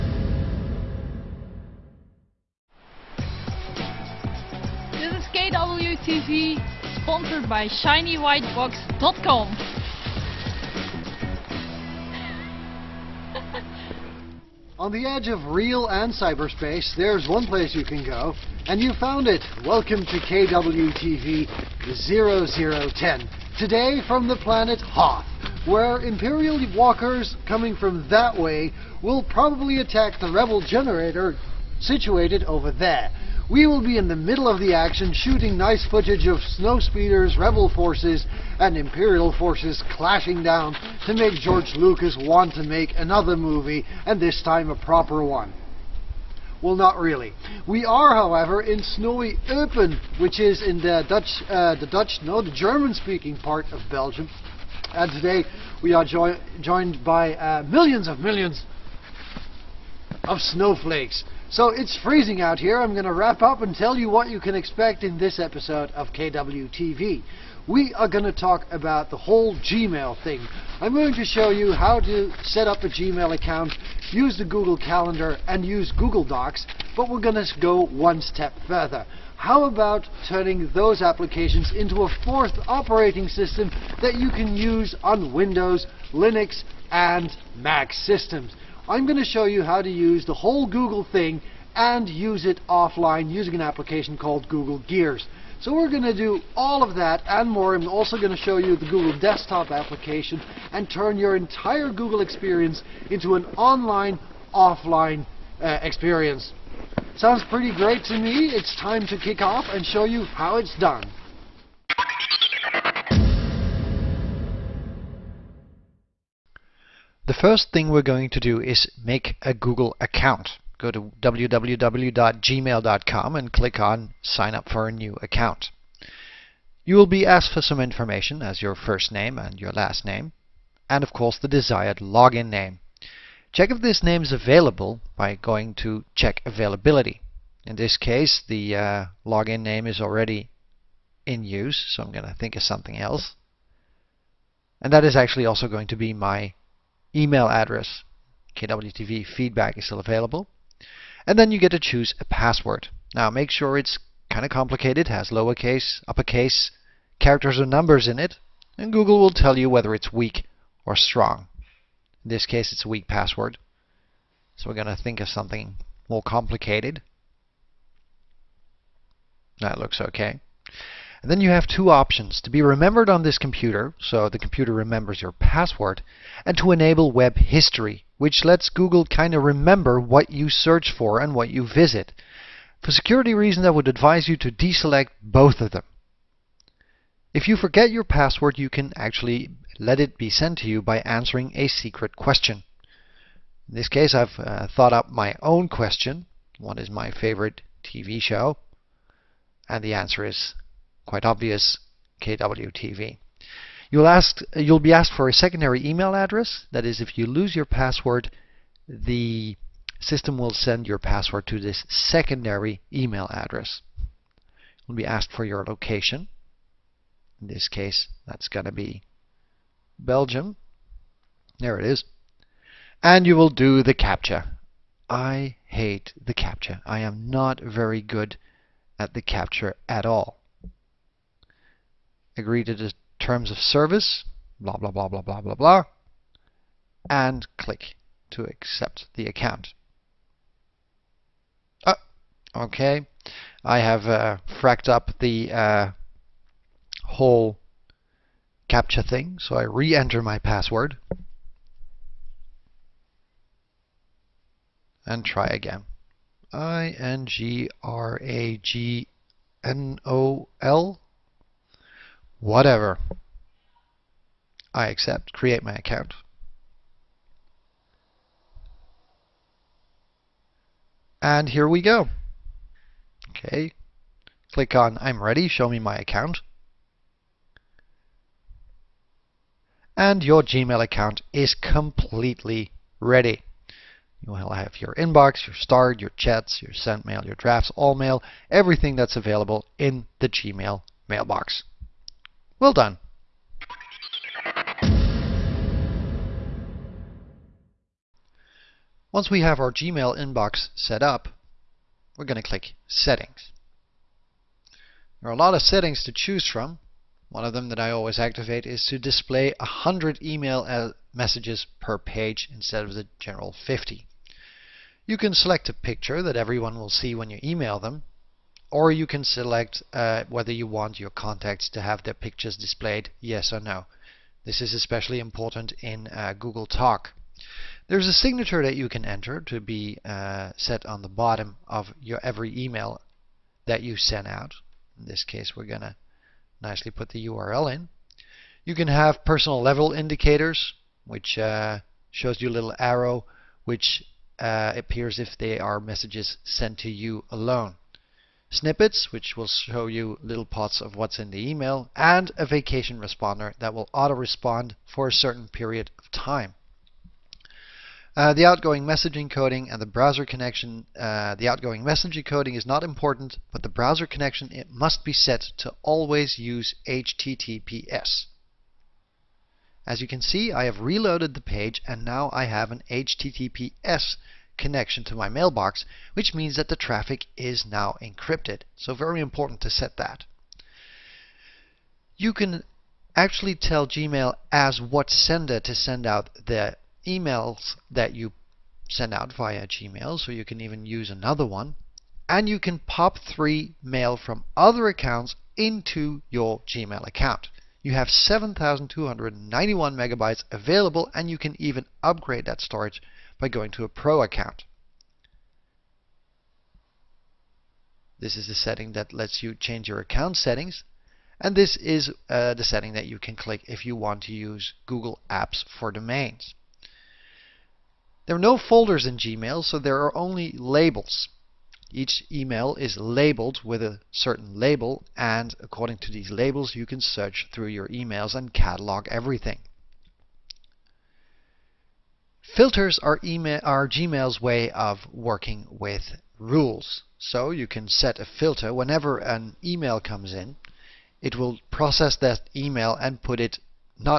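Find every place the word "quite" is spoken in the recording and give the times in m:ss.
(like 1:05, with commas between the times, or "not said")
3:21.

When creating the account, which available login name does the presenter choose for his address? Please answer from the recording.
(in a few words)
KWTV feedback.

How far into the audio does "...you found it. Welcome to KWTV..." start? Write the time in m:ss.
0:18.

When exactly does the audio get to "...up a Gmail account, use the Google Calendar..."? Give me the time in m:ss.
1:12.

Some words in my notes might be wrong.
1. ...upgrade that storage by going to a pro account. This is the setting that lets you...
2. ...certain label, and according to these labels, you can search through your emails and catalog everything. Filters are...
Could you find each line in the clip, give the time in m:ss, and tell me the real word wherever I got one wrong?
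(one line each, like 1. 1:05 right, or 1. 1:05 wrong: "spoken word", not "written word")
1. 6:42 right
2. 7:04 right.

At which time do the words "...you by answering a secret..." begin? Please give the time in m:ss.
3:10.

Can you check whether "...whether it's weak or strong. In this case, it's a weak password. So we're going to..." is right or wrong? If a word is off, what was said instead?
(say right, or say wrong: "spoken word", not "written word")
right.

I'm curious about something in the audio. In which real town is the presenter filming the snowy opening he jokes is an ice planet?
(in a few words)
Eupen.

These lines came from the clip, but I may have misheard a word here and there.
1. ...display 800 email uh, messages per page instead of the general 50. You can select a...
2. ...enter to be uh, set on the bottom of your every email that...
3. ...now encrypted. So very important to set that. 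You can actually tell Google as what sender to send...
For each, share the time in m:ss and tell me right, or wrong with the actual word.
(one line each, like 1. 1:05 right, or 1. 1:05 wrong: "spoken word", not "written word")
1. 5:08 wrong: "100", not "800"
2. 5:29 right
3. 6:17 wrong: "Gmail", not "Google".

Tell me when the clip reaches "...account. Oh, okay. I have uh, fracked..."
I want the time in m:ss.
3:59.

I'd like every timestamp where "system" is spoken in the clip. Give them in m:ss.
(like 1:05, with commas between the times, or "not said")
1:23, 1:27, 3:30.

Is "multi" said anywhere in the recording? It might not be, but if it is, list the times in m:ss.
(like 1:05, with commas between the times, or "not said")
not said.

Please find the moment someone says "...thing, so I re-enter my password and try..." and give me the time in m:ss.
4:09.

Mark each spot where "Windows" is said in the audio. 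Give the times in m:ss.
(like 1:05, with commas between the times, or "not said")
1:25.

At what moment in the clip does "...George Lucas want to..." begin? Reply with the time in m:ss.
0:41.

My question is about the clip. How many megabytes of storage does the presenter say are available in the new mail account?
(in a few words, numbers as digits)
7,291.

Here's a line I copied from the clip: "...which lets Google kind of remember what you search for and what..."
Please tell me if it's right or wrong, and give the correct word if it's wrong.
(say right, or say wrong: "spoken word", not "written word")
right.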